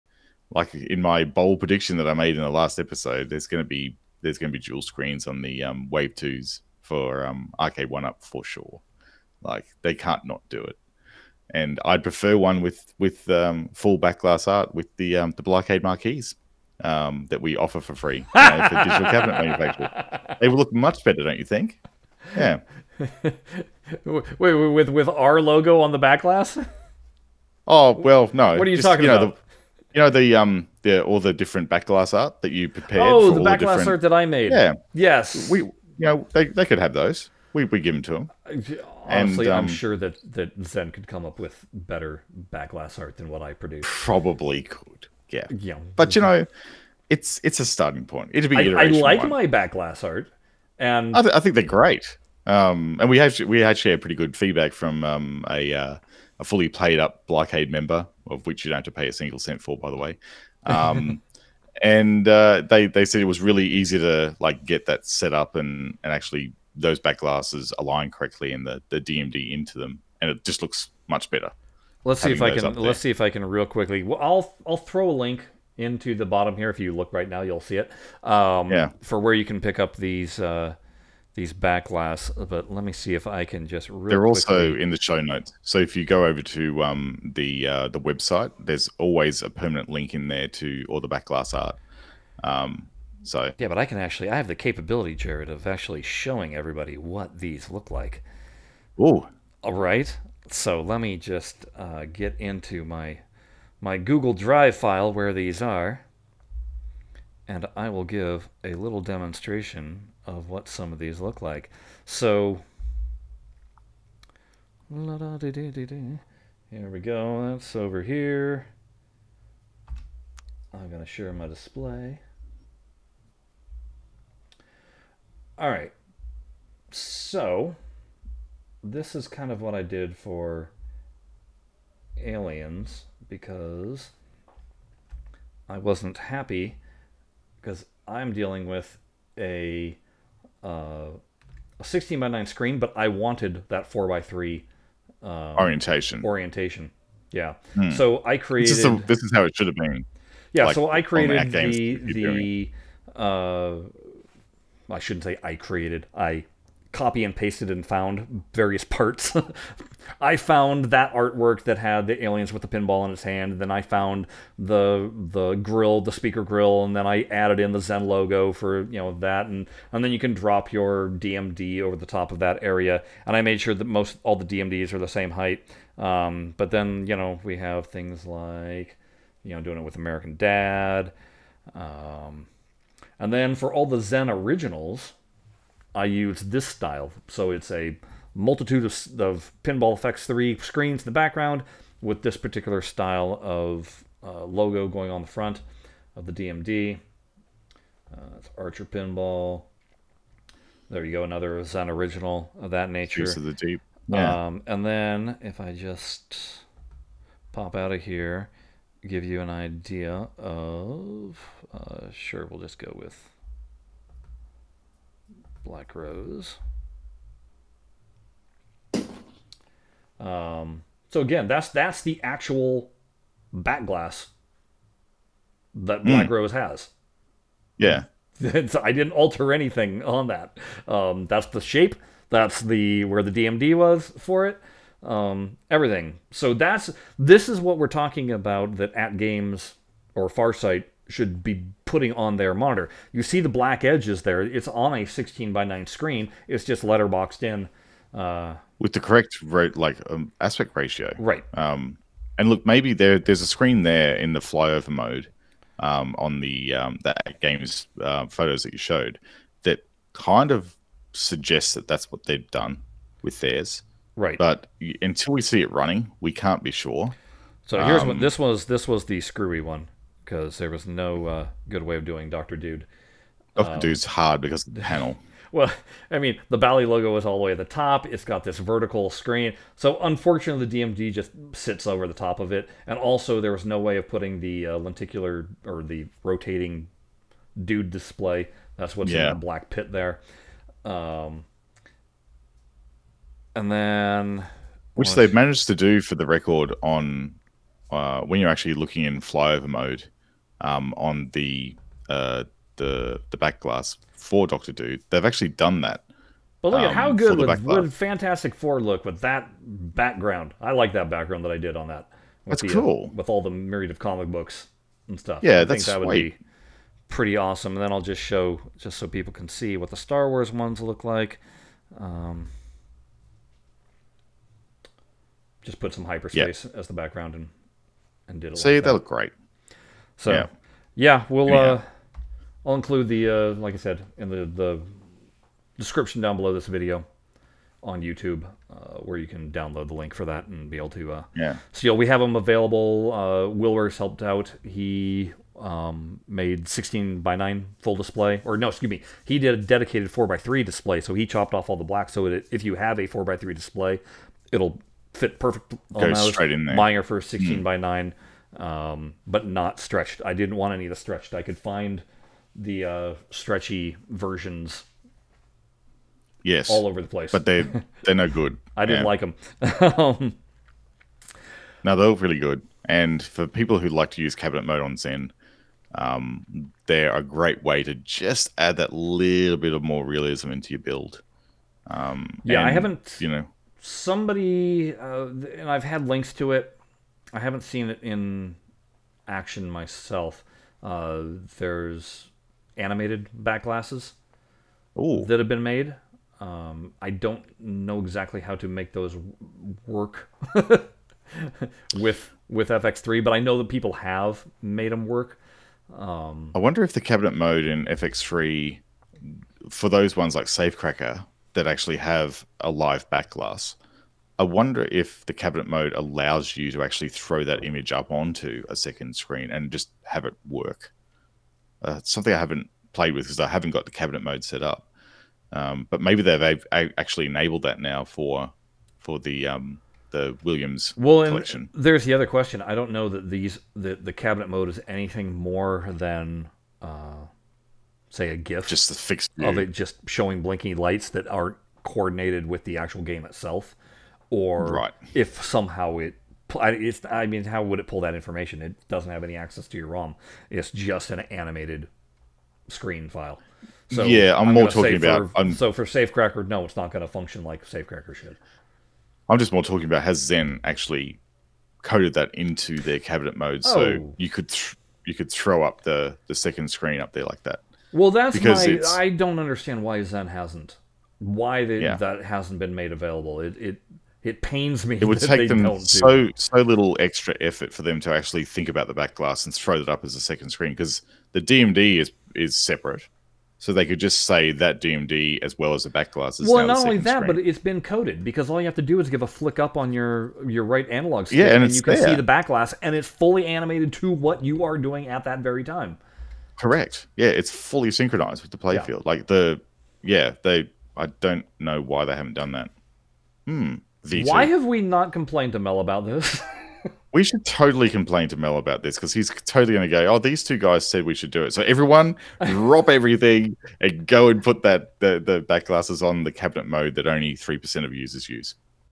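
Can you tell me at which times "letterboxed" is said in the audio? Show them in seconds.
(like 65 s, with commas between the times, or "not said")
246 s.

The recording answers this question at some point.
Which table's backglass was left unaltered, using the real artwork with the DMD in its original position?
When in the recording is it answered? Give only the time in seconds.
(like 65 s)
215 s.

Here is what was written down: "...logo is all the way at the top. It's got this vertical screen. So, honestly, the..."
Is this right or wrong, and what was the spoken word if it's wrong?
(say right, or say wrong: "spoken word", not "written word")
wrong: "unfortunately", not "honestly".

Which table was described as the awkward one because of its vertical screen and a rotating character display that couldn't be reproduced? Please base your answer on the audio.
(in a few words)
Doctor Dude.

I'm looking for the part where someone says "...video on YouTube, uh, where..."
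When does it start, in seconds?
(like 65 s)
336 s.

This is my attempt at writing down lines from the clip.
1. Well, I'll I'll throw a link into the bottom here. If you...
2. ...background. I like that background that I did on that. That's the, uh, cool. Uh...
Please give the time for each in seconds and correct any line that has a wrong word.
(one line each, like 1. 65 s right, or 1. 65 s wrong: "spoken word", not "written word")
1. 74 s right
2. 309 s right.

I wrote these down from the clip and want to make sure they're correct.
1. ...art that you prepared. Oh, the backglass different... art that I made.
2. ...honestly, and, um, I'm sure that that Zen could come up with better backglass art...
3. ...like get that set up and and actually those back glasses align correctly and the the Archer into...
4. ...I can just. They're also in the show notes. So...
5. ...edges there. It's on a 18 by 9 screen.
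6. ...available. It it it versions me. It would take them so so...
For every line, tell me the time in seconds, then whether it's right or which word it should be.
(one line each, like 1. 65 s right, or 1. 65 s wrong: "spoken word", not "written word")
1. 32 s right
2. 39 s right
3. 64 s wrong: "DMD", not "Archer"
4. 83 s right
5. 243 s wrong: "16", not "18"
6. 472 s wrong: "pains", not "versions".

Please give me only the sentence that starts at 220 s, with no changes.
Um, so again, that's that's the actual back glass that hmm.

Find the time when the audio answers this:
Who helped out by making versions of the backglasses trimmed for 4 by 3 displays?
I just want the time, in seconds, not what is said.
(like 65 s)
343 s.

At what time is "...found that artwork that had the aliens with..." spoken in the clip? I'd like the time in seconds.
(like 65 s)
160 s.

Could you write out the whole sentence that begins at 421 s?
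Uh, it's something I haven't played with because I haven't got the cabinet mode set up.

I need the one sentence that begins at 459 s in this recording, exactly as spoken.
I'm just more talking about has Zen actually coded that into their cabinet mode, oh.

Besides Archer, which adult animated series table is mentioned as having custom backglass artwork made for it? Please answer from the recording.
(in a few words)
American Dad.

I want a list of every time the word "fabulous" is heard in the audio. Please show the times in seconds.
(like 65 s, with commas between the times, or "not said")
not said.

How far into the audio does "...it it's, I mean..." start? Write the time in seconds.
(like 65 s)
445 s.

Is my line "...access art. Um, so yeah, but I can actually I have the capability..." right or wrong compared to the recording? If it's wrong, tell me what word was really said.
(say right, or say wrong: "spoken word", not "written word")
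wrong: "backglass", not "access".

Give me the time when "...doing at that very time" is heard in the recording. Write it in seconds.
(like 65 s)
494 s.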